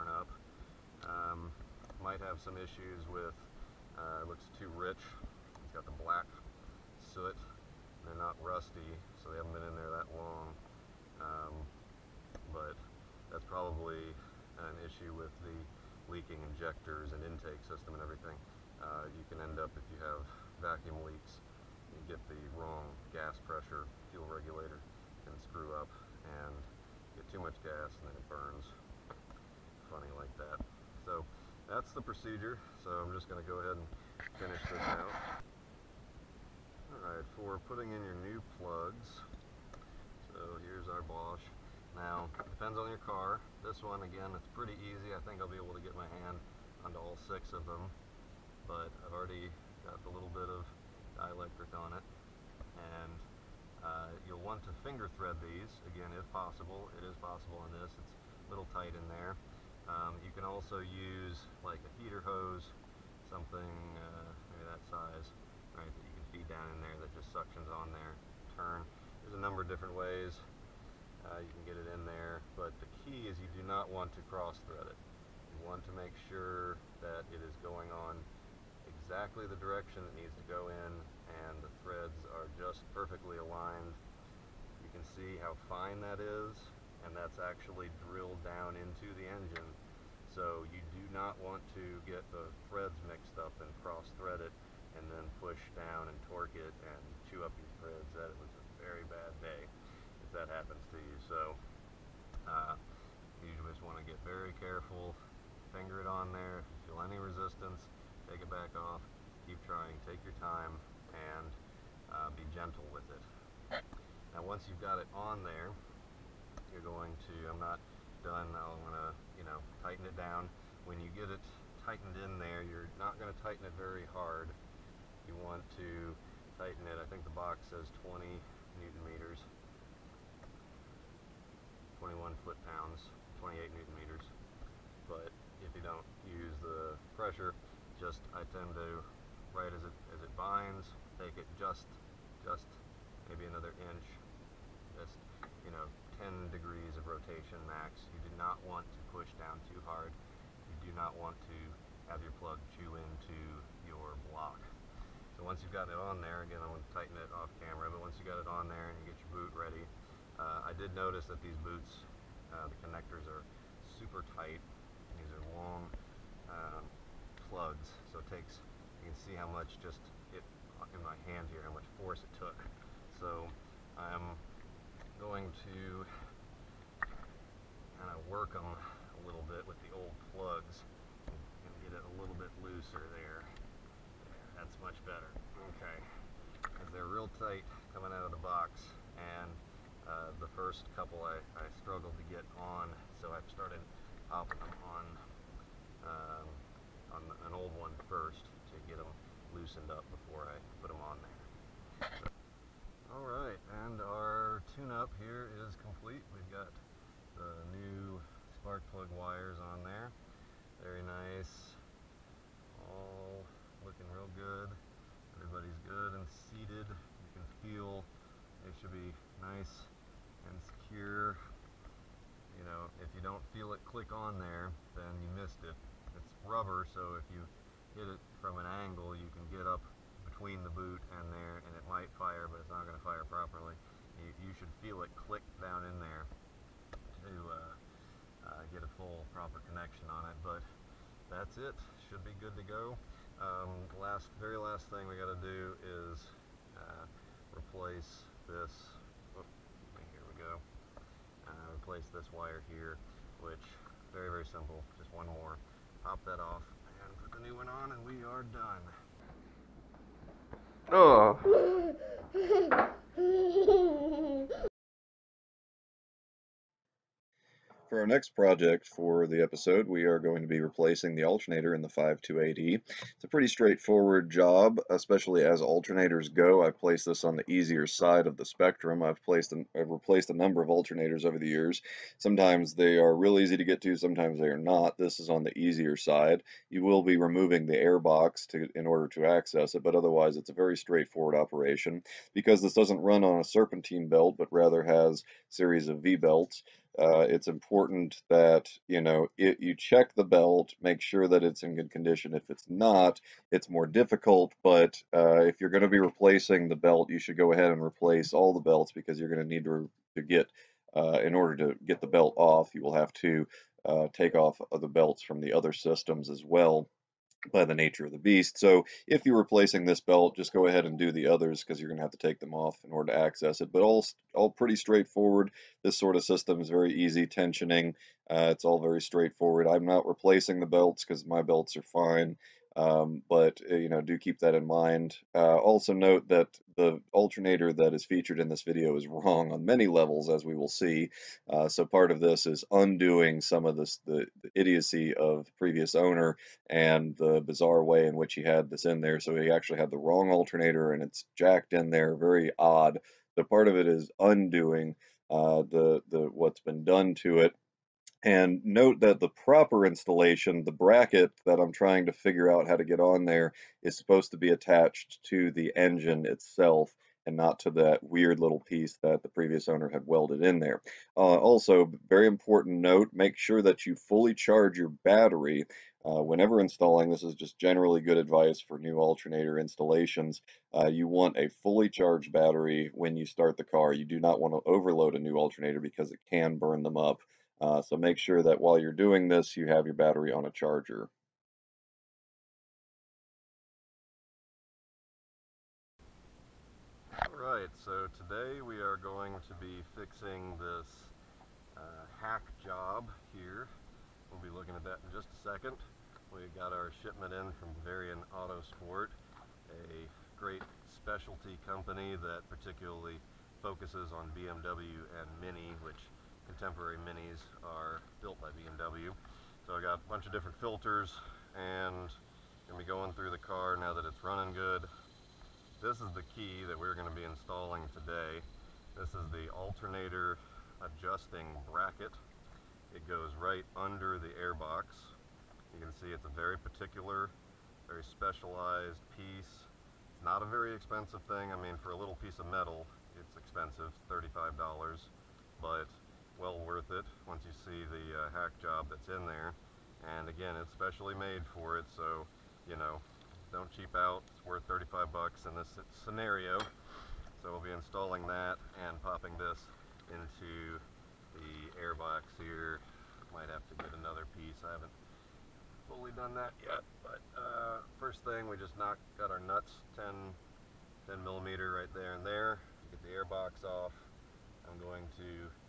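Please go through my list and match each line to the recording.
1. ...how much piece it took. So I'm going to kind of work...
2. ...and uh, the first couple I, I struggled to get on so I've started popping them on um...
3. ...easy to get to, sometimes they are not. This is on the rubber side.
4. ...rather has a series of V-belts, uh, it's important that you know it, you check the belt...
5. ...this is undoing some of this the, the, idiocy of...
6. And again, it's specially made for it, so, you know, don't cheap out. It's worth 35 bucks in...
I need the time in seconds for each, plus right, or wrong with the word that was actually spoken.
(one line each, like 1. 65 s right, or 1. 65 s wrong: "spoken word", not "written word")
1. 171 s wrong: "force", not "piece"
2. 189 s right
3. 283 s wrong: "easier", not "rubber"
4. 294 s right
5. 342 s right
6. 450 s right.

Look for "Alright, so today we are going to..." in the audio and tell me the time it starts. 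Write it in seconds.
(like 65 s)
397 s.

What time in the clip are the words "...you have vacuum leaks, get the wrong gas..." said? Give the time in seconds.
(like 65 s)
19 s.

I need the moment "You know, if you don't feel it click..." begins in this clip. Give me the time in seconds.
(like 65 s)
222 s.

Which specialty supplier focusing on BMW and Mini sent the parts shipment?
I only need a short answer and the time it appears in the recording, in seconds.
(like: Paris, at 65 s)
Bavarian Autosport, at 407 s.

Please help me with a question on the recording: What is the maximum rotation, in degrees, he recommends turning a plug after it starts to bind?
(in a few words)
10.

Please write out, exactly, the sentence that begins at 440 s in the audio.
It's not a very expensive thing.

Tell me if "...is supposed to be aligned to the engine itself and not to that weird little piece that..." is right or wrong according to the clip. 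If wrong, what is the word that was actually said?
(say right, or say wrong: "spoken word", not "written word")
wrong: "attached", not "aligned".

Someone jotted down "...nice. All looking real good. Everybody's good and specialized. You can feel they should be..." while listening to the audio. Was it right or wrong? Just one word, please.
wrong.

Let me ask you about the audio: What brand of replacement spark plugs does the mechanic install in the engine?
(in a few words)
Bosch.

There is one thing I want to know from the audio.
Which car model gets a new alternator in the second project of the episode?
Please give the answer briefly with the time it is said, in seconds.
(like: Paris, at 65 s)
528E, at 271 s.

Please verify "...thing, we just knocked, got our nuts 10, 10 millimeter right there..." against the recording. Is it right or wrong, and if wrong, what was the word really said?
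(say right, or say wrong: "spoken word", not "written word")
right.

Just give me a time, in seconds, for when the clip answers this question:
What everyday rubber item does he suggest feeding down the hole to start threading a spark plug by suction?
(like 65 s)
62 s.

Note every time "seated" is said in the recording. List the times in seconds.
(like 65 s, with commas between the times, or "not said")
216 s.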